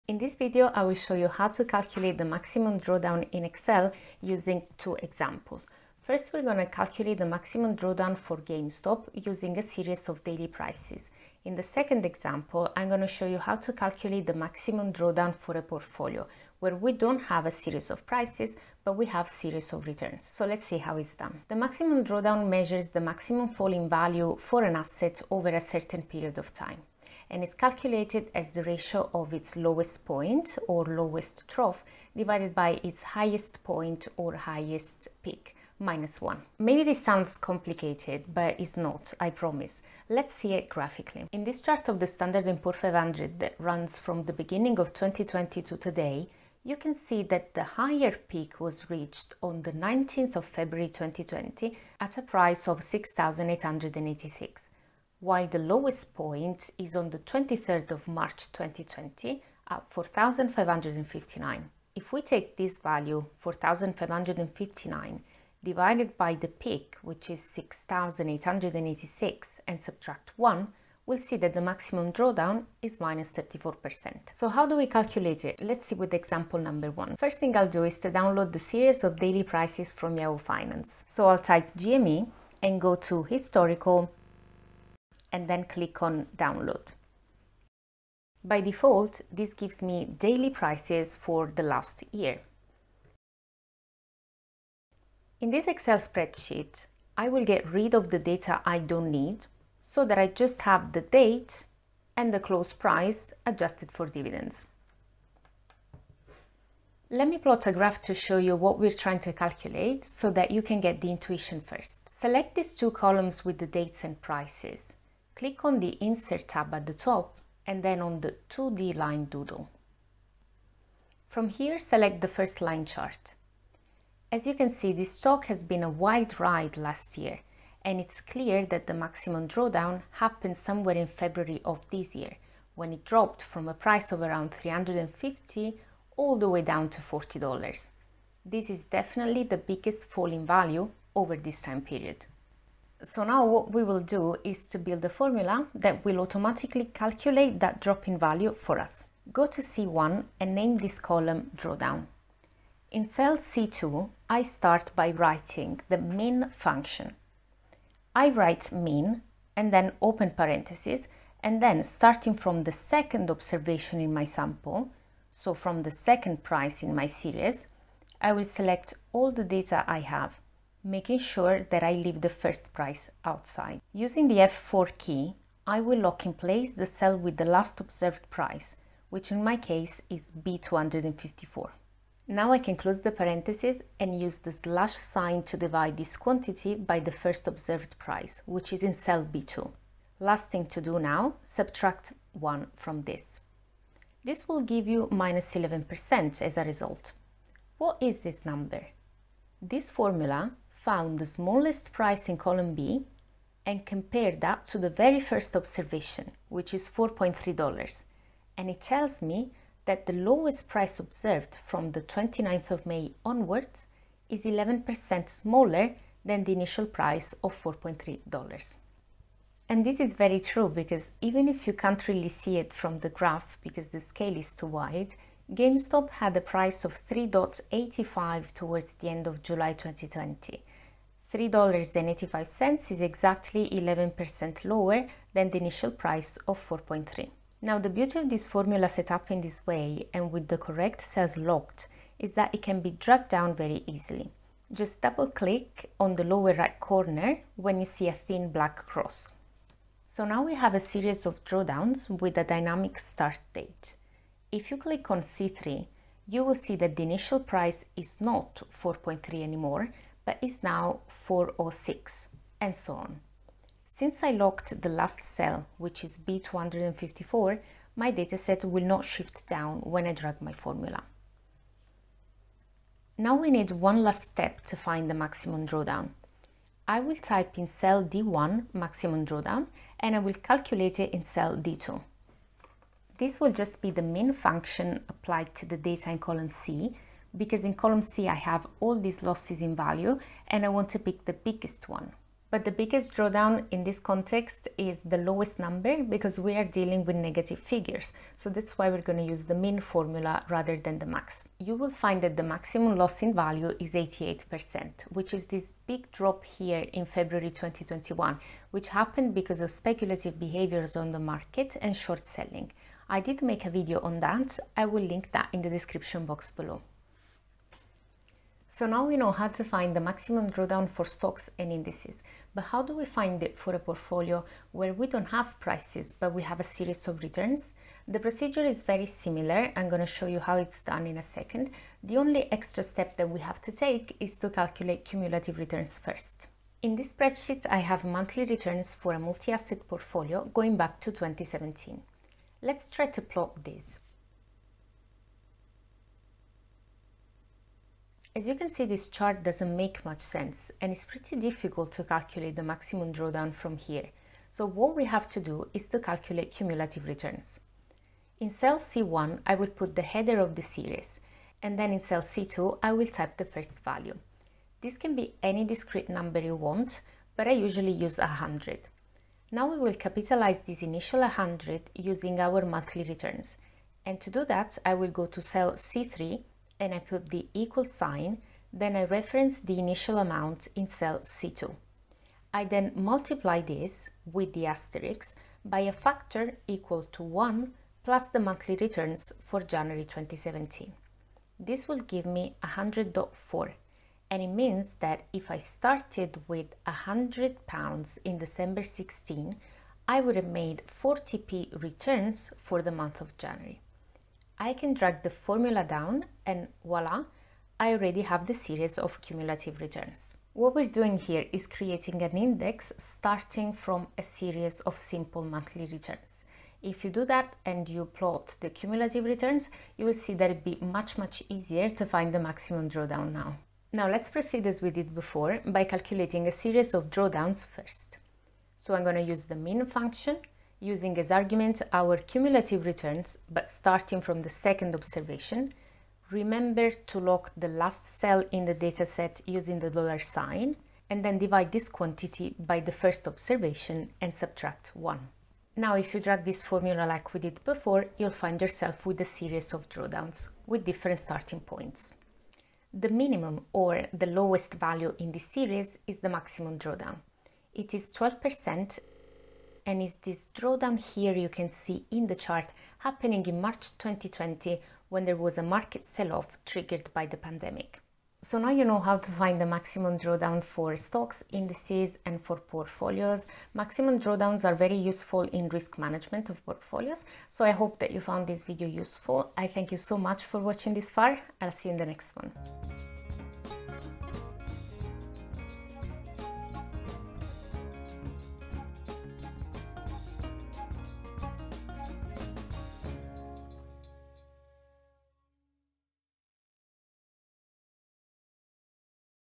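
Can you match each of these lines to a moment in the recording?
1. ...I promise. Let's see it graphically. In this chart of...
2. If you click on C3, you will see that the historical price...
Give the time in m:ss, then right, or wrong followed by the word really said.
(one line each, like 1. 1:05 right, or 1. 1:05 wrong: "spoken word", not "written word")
1. 0:39 right
2. 4:14 wrong: "initial", not "historical".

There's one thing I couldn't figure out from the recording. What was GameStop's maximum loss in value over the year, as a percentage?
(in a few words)
88%.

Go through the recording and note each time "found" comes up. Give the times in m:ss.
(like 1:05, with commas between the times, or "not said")
3:20, 7:58.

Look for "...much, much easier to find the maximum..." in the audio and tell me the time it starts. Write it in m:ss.
7:00.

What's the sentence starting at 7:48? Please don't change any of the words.
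So now you know how to find the maximum drawdown for stocks, indices and for portfolios.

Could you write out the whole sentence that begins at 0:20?
So let's see how it's done.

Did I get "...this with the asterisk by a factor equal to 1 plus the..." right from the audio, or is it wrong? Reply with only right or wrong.
right.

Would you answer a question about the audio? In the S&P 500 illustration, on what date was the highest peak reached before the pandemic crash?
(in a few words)
19th of February 2020.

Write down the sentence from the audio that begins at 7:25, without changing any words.
Now, if you drag this formula like we did before, you'll find yourself with a series of drawdowns with different starting points.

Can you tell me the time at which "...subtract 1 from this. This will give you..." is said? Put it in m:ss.
3:11.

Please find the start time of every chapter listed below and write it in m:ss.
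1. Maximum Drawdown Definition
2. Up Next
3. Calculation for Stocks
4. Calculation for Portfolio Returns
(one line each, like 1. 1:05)
1. 0:20
2. 8:00
3. 1:14
4. 5:17.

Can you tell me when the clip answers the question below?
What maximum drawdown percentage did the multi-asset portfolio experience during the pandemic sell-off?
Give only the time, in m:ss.
7:38.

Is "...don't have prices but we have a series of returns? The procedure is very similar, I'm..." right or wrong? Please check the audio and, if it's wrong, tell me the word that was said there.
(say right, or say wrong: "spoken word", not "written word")
right.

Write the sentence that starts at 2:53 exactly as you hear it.
Using the F4 key, I will lock in place the cell with the last observed price, which in my case is B254.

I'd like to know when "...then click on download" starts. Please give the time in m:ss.
1:25.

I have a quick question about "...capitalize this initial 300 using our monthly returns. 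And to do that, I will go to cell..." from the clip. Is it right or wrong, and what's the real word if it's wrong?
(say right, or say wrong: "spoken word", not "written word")
wrong: "100", not "300".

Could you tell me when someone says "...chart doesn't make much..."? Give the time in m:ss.
5:49.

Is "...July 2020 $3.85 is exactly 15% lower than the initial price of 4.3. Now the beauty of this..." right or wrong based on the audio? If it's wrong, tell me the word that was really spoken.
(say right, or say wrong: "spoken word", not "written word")
wrong: "11", not "15".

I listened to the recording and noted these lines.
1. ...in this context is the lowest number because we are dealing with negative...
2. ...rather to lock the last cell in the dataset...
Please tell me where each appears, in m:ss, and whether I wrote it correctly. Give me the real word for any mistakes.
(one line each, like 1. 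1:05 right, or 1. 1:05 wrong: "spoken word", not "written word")
1. 4:53 right
2. 7:16 wrong: "remember", not "rather".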